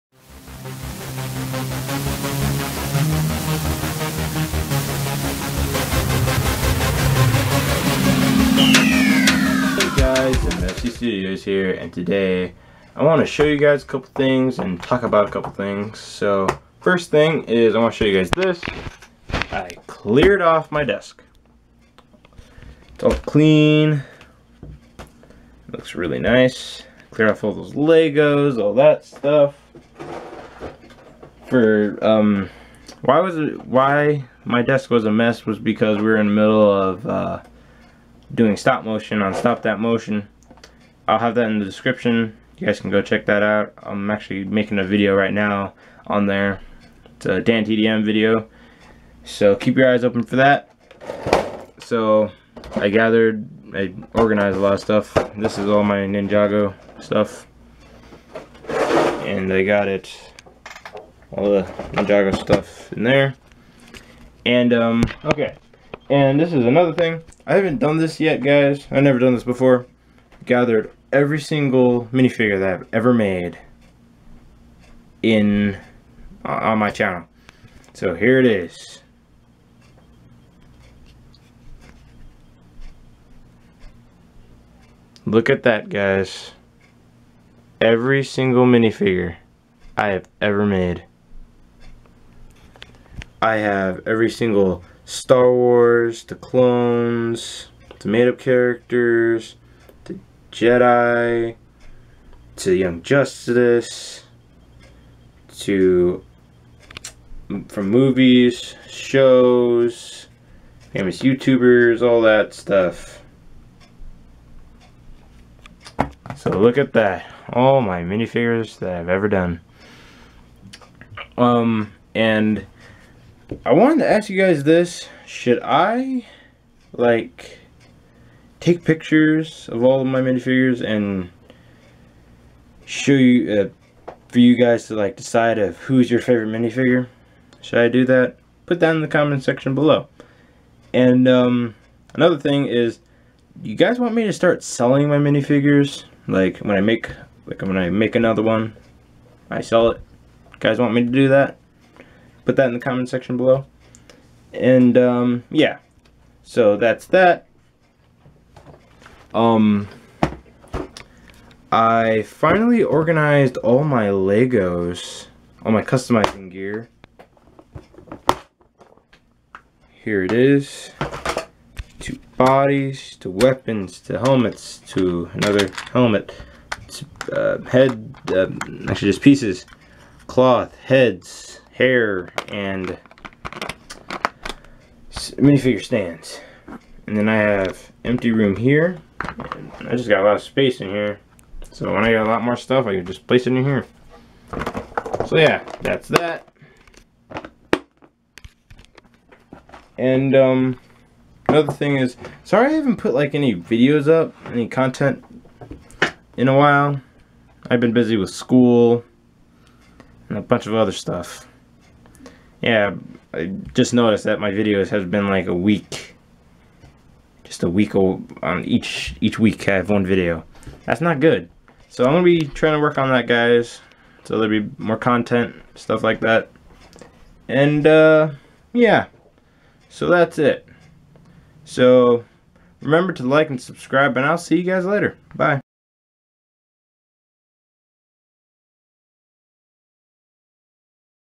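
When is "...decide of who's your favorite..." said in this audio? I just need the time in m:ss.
2:15.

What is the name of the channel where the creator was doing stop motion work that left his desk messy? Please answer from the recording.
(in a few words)
Stop That Motion.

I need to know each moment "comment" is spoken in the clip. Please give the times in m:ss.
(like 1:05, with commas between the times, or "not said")
2:19, 2:32.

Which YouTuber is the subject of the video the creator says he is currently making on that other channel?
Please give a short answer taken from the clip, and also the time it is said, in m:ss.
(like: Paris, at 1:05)
Dan TDM, at 0:47.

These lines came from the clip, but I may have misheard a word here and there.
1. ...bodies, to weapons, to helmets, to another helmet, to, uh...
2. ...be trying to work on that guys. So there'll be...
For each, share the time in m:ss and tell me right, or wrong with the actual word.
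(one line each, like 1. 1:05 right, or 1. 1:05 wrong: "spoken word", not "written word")
1. 2:52 right
2. 3:42 right.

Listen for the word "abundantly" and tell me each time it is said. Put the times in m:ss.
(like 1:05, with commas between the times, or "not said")
not said.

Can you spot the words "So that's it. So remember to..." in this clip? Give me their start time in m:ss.
3:49.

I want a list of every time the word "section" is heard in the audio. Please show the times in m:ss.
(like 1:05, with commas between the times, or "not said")
2:19, 2:33.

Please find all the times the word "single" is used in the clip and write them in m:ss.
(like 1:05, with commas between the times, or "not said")
1:11, 1:28, 1:34.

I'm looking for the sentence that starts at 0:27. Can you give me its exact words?
Clear off all those Legos, all that stuff.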